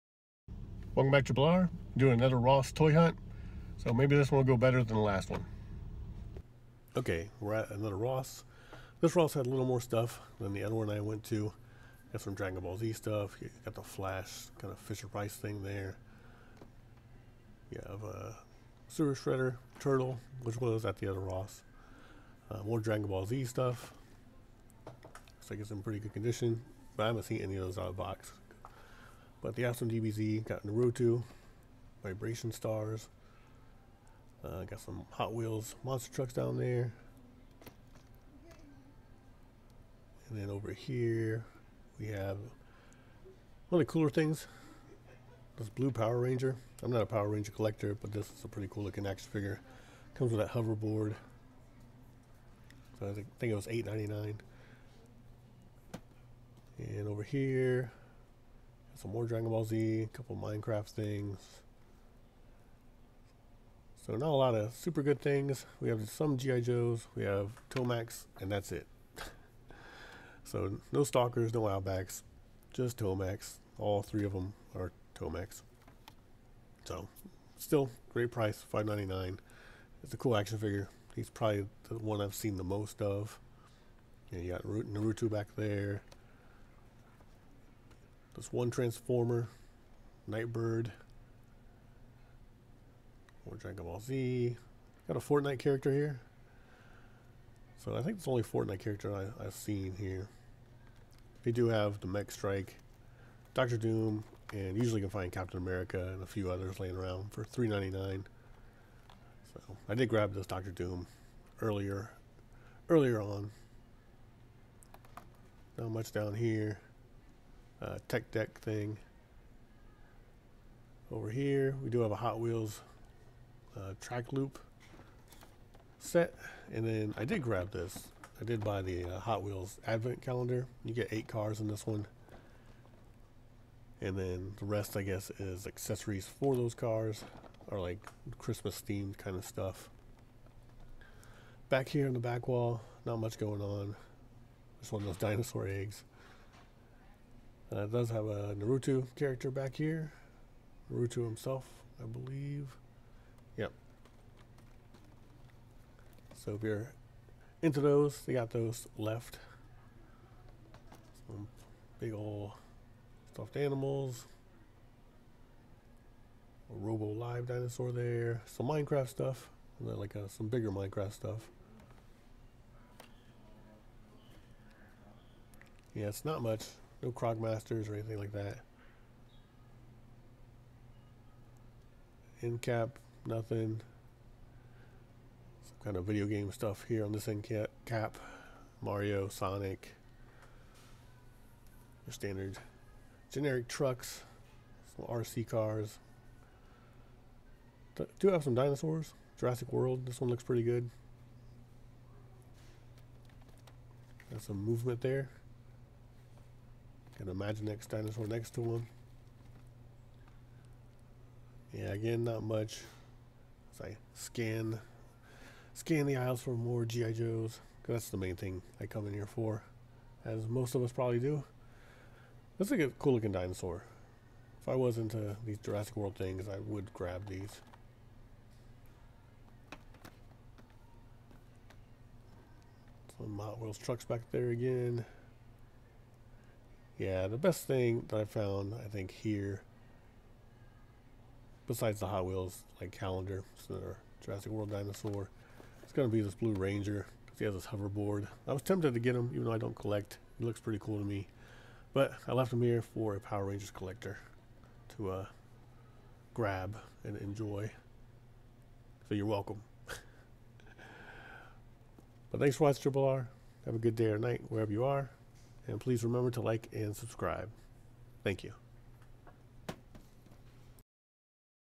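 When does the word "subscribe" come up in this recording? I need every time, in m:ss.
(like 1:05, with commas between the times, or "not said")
4:26.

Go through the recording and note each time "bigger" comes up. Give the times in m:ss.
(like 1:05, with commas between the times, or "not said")
2:50.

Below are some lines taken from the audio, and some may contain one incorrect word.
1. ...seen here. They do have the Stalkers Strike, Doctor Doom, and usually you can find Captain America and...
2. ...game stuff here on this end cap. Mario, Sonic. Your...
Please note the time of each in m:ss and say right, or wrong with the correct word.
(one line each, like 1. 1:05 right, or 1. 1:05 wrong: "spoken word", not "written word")
1. 1:39 wrong: "Mech", not "Stalkers"
2. 3:06 right.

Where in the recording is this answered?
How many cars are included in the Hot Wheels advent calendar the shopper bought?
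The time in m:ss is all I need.
2:11.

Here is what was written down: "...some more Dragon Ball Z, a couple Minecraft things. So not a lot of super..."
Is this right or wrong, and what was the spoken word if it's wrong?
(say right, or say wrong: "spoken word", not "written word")
right.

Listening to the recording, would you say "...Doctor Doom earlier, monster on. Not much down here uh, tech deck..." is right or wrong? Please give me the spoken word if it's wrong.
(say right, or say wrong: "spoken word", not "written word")
wrong: "earlier", not "monster".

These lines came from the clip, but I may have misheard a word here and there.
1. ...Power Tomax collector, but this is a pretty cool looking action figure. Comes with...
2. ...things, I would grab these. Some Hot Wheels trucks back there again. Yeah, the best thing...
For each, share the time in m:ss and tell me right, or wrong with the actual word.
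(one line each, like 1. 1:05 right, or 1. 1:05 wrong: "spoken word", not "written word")
1. 0:47 wrong: "Ranger", not "Tomax"
2. 3:46 right.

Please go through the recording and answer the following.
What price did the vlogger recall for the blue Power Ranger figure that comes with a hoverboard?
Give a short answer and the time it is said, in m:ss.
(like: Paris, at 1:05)
$8.99, at 0:53.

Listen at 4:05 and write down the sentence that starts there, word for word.
It's gonna be this Blue Ranger because he has this hoverboard.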